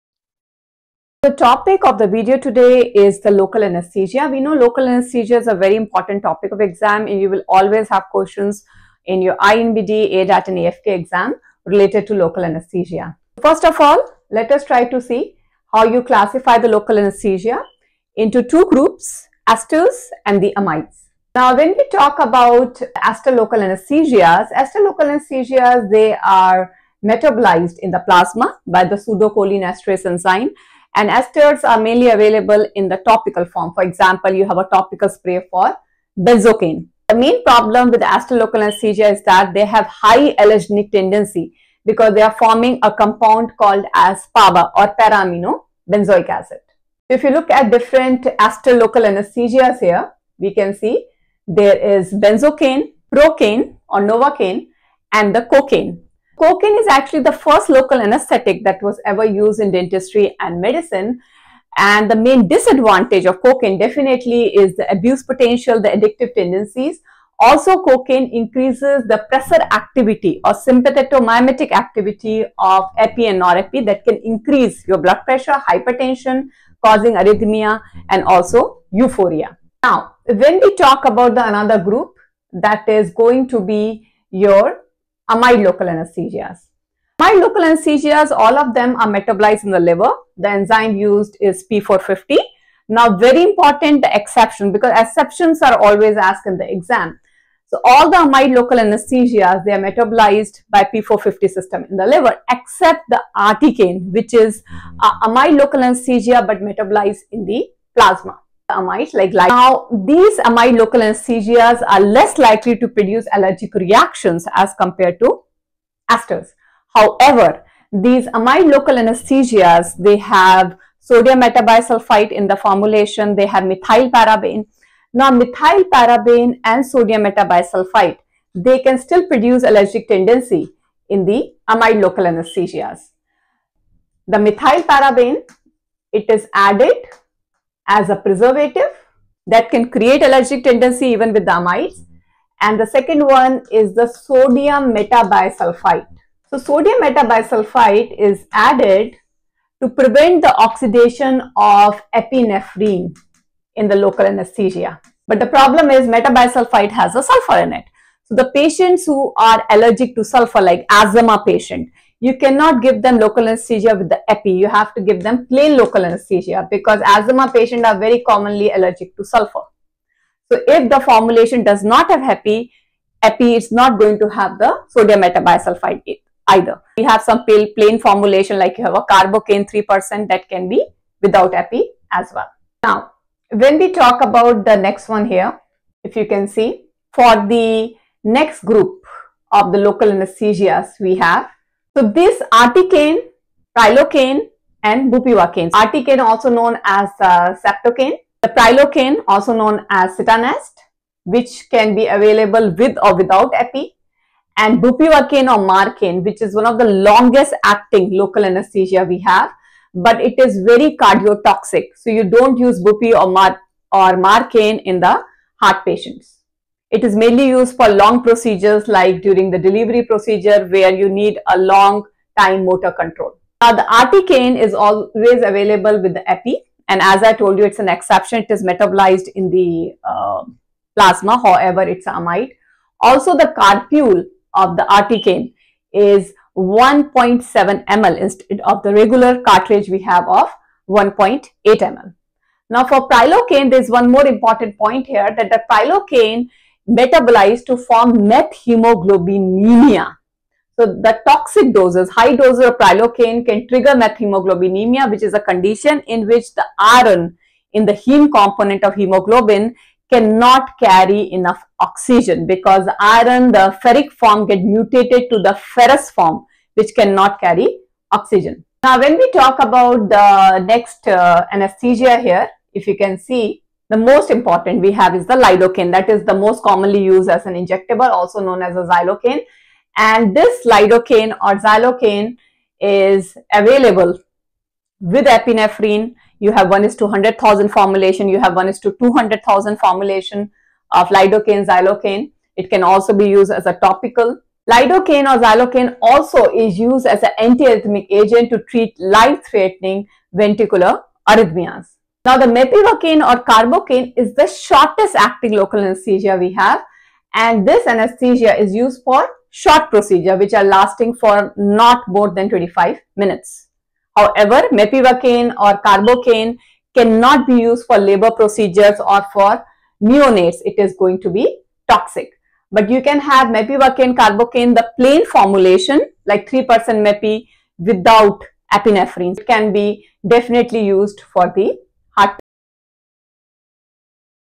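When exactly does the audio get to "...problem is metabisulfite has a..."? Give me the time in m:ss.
2:35.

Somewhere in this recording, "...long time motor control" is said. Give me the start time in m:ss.
3:41.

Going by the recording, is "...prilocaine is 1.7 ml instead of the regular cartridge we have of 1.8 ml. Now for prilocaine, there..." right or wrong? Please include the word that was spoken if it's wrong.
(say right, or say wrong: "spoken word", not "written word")
wrong: "articaine", not "prilocaine".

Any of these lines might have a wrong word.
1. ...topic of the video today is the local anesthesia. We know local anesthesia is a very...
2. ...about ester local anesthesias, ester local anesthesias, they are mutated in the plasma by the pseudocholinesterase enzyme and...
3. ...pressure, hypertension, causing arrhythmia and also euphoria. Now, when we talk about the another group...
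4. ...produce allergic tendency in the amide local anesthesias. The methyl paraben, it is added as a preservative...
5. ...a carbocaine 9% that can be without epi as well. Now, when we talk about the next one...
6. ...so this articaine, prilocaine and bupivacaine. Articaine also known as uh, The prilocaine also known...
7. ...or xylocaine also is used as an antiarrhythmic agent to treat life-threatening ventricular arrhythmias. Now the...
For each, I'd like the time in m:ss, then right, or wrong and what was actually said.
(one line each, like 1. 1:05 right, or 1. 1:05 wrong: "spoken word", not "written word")
1. 0:01 right
2. 0:22 wrong: "metabolized", not "mutated"
3. 1:15 right
4. 2:09 right
5. 2:58 wrong: "3", not "9"
6. 3:11 right
7. 4:55 right.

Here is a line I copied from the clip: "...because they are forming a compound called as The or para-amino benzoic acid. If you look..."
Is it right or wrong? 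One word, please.
wrong.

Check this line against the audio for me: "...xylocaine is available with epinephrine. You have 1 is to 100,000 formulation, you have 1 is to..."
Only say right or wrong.
right.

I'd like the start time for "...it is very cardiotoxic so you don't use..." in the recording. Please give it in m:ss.
3:30.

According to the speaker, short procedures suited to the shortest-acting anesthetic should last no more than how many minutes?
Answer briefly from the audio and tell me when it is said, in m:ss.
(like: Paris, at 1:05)
25 minutes, at 5:12.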